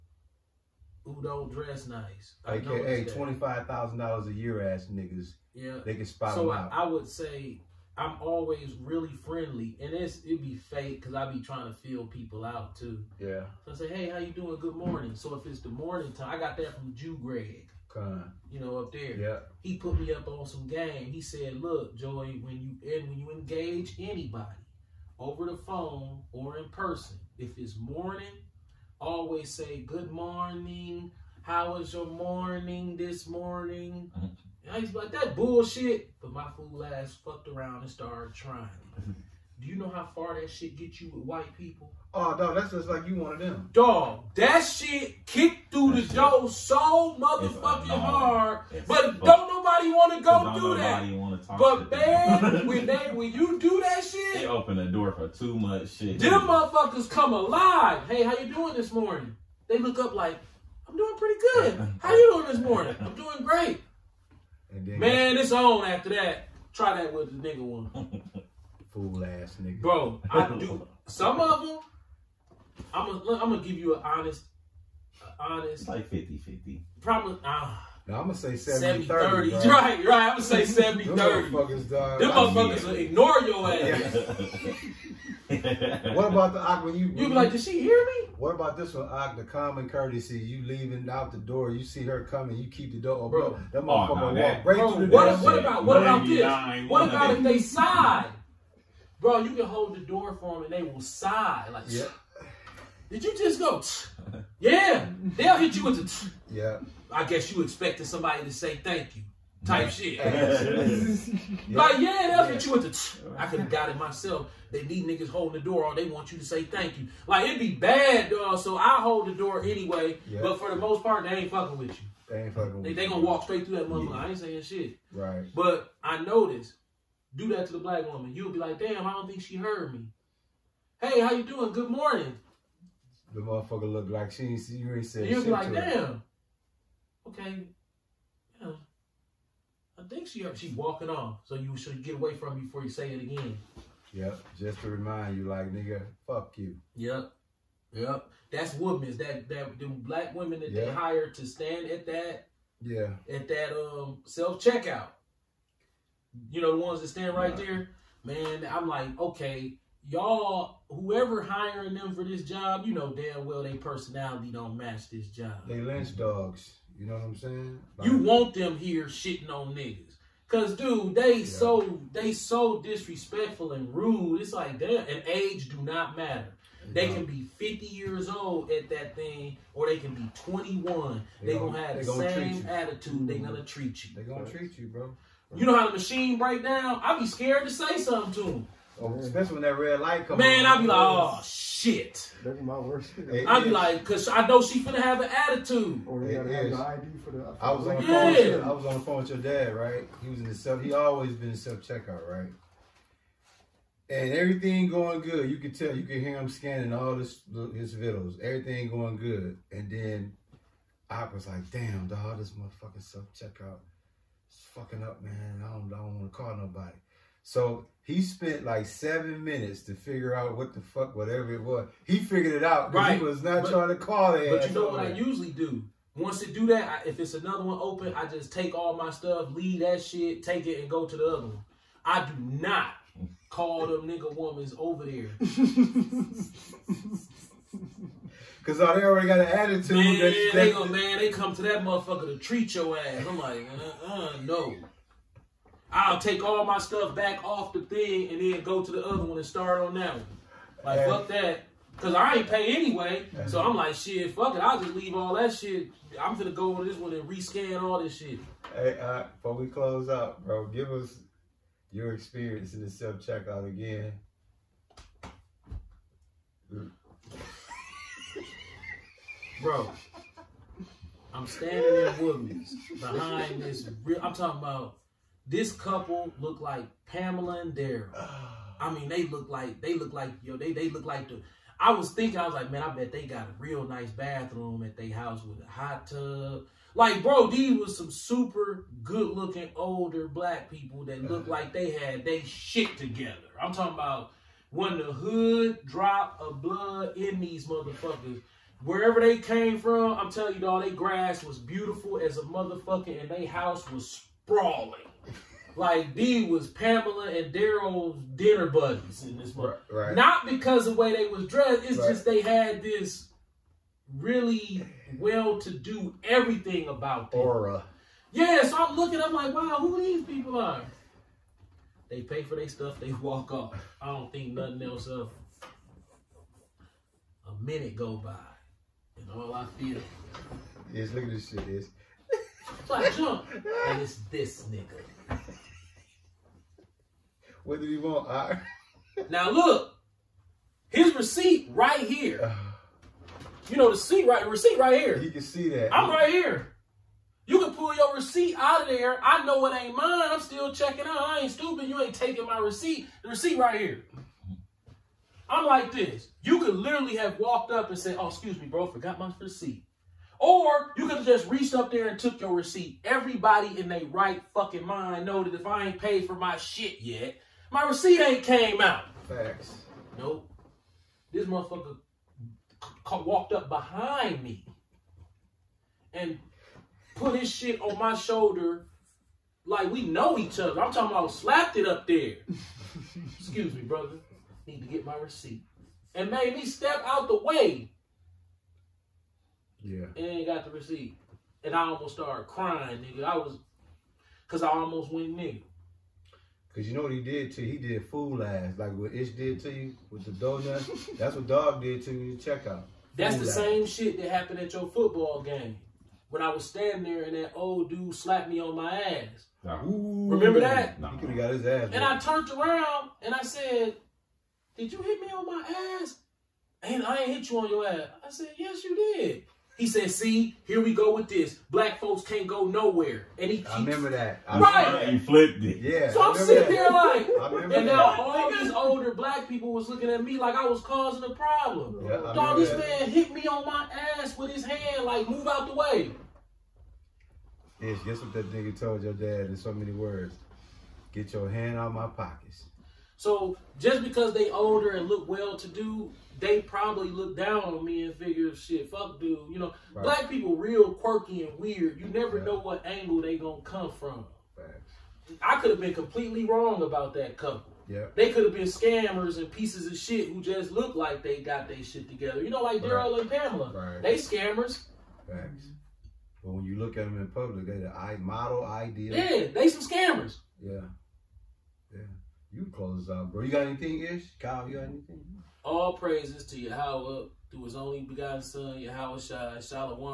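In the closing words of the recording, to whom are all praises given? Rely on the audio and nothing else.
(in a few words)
Yahweh.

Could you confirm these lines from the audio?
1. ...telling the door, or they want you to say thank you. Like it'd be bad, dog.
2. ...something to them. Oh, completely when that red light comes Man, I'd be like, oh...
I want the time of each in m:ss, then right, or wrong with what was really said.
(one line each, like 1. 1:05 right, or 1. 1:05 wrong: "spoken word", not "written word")
1. 1:55 wrong: "holding", not "telling"
2. 3:07 wrong: "especially", not "completely".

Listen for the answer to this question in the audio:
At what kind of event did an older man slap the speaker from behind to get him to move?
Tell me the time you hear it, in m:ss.
6:44.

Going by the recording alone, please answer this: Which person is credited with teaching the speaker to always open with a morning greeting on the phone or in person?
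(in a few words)
Greg.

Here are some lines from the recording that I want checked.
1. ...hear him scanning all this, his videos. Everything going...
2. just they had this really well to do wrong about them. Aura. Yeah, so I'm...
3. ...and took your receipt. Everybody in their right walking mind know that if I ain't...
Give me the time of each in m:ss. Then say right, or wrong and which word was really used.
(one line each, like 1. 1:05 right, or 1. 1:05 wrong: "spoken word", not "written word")
1. 3:26 right
2. 5:12 wrong: "everything", not "wrong"
3. 6:02 wrong: "fucking", not "walking".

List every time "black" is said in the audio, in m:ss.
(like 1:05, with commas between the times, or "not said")
2:07, 2:29, 4:50, 7:01, 7:09, 7:30.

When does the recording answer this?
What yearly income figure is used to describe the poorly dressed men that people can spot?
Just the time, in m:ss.
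0:03.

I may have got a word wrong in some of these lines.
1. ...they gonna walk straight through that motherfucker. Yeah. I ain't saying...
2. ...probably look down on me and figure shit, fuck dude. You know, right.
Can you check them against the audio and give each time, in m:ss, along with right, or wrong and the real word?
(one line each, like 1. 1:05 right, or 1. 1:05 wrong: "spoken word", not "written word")
1. 2:02 right
2. 7:26 right.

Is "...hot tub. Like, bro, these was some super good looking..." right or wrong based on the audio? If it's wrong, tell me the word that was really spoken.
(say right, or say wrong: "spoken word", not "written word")
right.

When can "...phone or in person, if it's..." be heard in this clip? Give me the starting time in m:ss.
0:25.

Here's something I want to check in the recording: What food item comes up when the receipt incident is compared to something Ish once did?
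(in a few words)
Donut.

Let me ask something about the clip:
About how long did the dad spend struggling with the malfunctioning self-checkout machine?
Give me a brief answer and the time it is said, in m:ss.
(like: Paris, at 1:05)
7 minutes, at 3:38.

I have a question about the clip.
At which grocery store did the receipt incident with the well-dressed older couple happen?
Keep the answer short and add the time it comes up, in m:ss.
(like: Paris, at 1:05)
Woodman's, at 4:32.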